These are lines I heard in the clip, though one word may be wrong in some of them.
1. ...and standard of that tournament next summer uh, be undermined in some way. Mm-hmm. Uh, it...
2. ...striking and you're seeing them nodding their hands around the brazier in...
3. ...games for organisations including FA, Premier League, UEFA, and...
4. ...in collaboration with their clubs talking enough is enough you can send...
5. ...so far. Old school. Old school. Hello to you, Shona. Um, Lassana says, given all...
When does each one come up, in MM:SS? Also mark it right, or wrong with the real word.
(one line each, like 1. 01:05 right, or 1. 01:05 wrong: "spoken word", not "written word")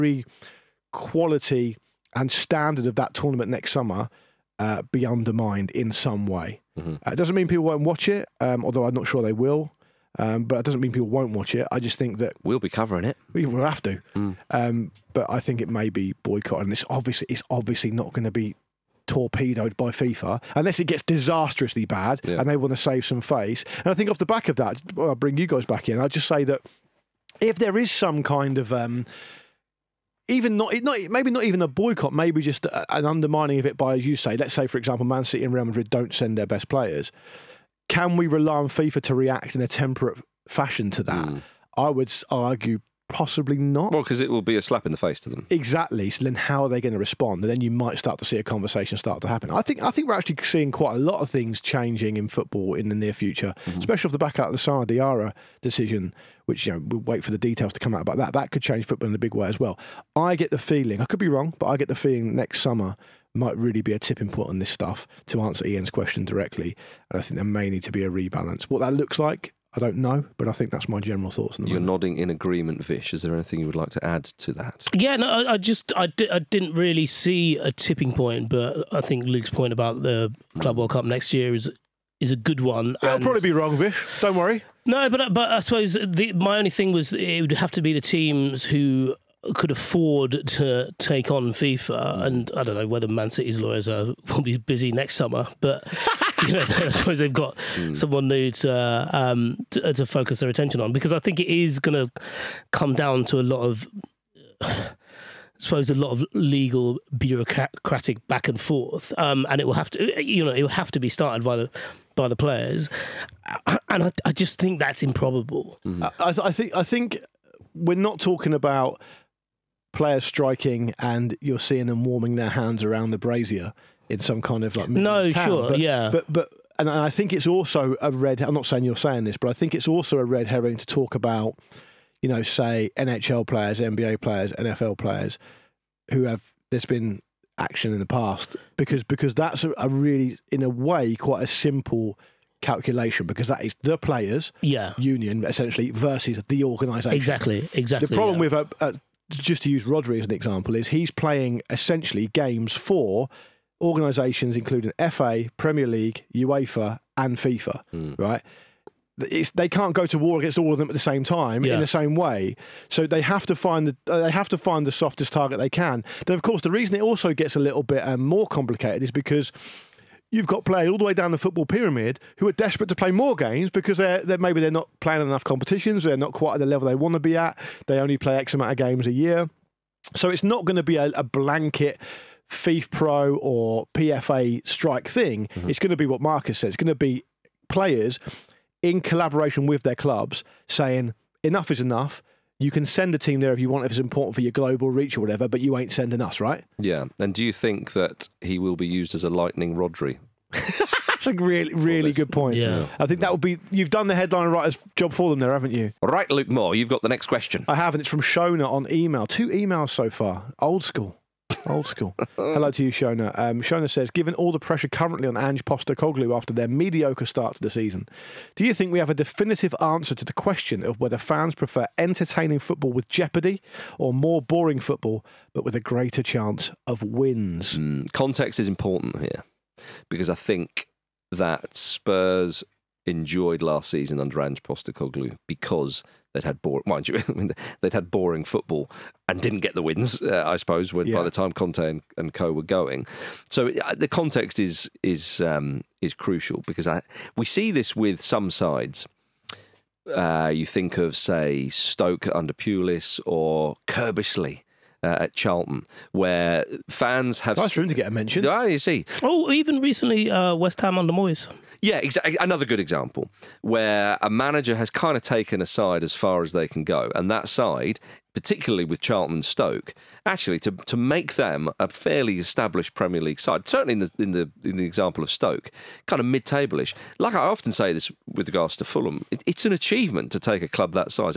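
1. 00:02 right
2. 02:00 wrong: "warming", not "nodding"
3. 02:32 right
4. 03:08 wrong: "saying", not "talking"
5. 03:29 wrong: "Shona", not "Lassana".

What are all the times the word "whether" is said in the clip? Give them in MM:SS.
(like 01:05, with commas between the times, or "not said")
01:32, 03:40.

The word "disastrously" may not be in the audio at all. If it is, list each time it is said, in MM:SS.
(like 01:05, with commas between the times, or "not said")
00:21.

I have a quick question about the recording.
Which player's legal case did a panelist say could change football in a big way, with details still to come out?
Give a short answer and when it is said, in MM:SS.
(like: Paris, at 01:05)
Lassana Diarra, at 00:54.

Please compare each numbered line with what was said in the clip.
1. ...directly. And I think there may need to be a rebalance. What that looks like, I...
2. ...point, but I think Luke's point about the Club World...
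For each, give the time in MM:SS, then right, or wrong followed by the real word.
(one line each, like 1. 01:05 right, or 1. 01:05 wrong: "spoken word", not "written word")
1. 01:06 right
2. 01:18 right.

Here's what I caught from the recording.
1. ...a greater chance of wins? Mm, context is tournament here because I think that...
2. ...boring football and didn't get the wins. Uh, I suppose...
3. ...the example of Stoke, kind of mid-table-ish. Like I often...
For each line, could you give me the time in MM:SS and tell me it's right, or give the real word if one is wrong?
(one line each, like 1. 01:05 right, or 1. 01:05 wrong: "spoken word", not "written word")
1. 03:45 wrong: "important", not "tournament"
2. 03:58 right
3. 04:34 right.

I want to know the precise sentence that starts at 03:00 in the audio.
So it's not going to be a, a blanket FIFA Pro or PFA strike thing.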